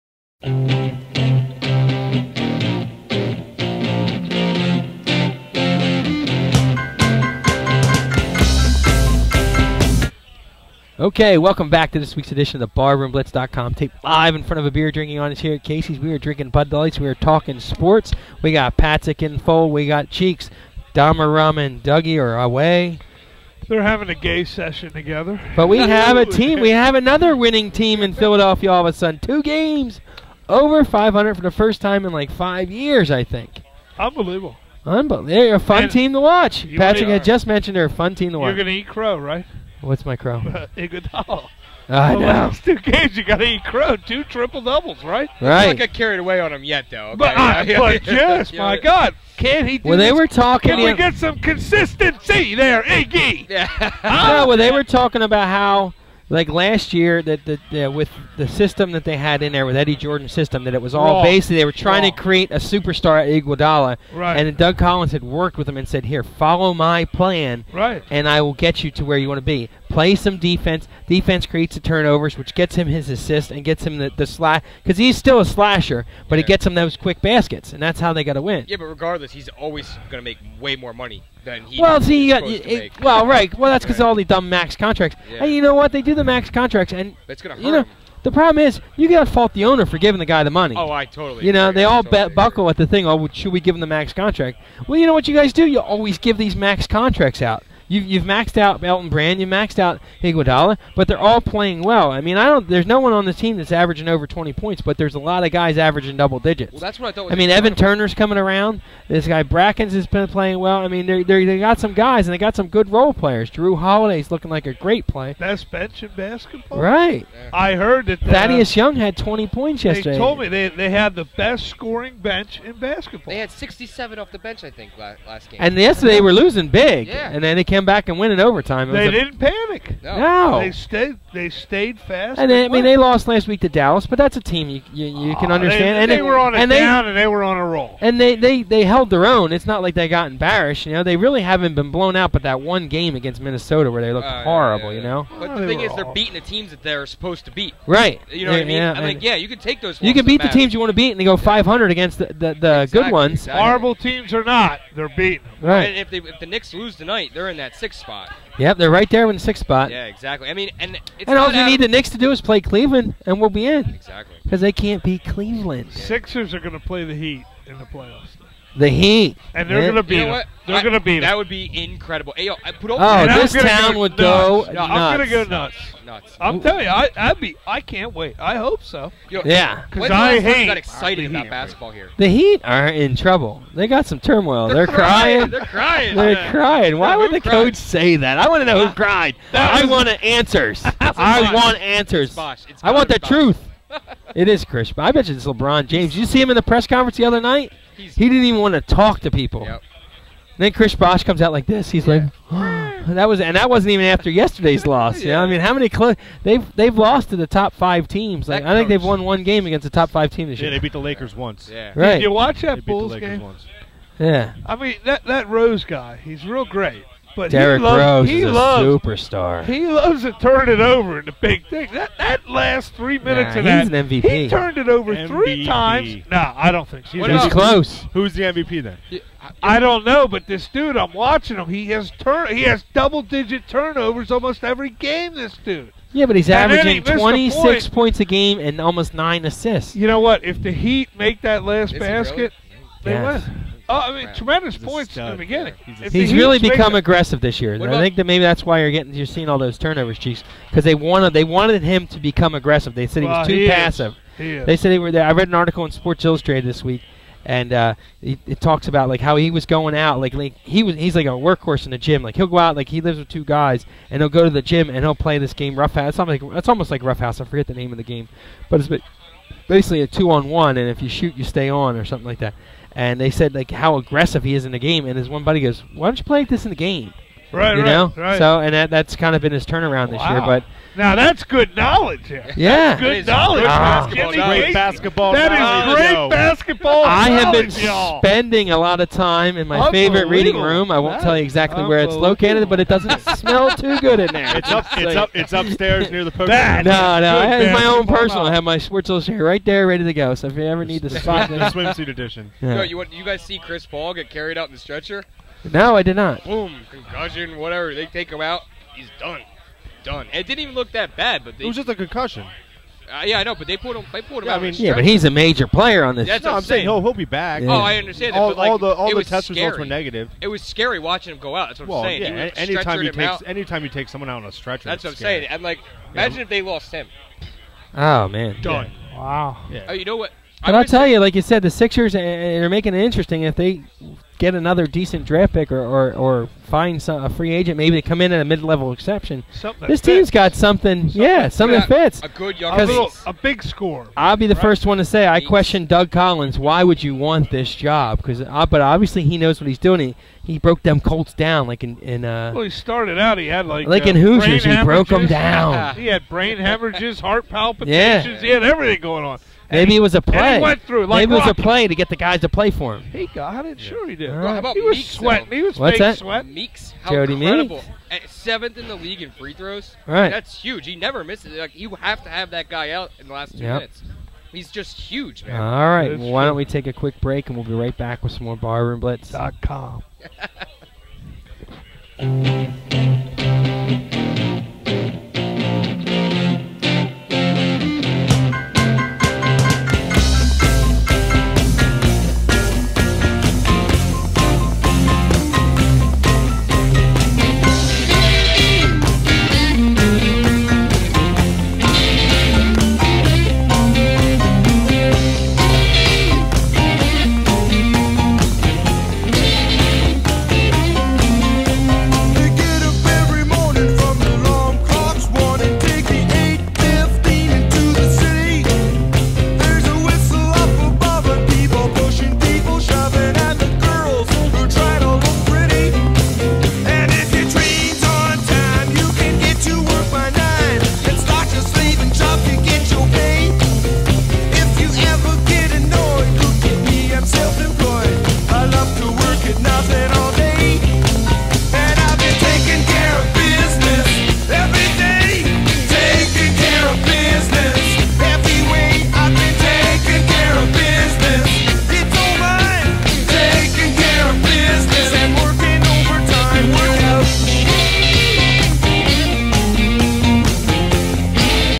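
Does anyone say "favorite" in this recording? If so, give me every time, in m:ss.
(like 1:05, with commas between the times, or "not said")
4:49.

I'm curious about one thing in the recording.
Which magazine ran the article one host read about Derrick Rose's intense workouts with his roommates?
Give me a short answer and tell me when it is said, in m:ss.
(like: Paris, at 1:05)
Sports Illustrated, at 4:15.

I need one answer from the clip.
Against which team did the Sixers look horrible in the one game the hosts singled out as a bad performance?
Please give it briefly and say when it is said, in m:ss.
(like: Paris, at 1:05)
Minnesota, at 2:23.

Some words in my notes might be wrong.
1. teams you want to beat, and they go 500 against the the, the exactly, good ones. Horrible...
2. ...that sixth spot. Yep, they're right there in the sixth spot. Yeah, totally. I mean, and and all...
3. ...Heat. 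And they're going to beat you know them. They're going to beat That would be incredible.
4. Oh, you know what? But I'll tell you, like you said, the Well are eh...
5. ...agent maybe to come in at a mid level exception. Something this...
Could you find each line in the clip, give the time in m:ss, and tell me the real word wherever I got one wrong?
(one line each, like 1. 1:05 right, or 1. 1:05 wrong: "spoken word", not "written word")
1. 2:30 right
2. 2:37 wrong: "exactly", not "totally"
3. 2:48 right
4. 5:29 wrong: "Sixers", not "Well"
5. 5:37 right.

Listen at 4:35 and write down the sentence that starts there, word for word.
And his one buddy goes, "Why don't you play like this in the game?" Right, you right, know.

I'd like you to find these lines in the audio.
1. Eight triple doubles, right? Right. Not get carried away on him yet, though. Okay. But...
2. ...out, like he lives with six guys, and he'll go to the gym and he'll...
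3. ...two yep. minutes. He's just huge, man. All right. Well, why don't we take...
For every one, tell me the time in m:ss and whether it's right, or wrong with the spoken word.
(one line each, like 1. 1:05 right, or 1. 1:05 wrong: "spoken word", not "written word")
1. 0:43 wrong: "Two", not "Eight"
2. 4:22 wrong: "two", not "six"
3. 6:13 right.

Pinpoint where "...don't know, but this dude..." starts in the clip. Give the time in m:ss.
3:49.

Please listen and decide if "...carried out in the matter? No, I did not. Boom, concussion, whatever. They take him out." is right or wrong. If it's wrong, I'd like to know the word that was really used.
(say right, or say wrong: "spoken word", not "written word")
wrong: "stretcher", not "matter".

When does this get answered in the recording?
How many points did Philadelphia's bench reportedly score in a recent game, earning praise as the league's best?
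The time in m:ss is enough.
2:03.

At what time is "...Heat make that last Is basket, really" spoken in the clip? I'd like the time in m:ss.
4:00.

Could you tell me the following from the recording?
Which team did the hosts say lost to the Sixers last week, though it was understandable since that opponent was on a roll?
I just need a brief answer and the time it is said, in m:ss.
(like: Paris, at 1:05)
Dallas, at 2:13.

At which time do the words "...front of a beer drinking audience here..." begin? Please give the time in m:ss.
0:14.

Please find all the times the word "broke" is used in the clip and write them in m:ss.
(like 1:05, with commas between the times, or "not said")
5:50, 5:54.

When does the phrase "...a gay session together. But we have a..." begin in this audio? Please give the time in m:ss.
0:24.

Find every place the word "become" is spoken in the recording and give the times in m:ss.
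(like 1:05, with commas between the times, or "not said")
4:06, 4:12.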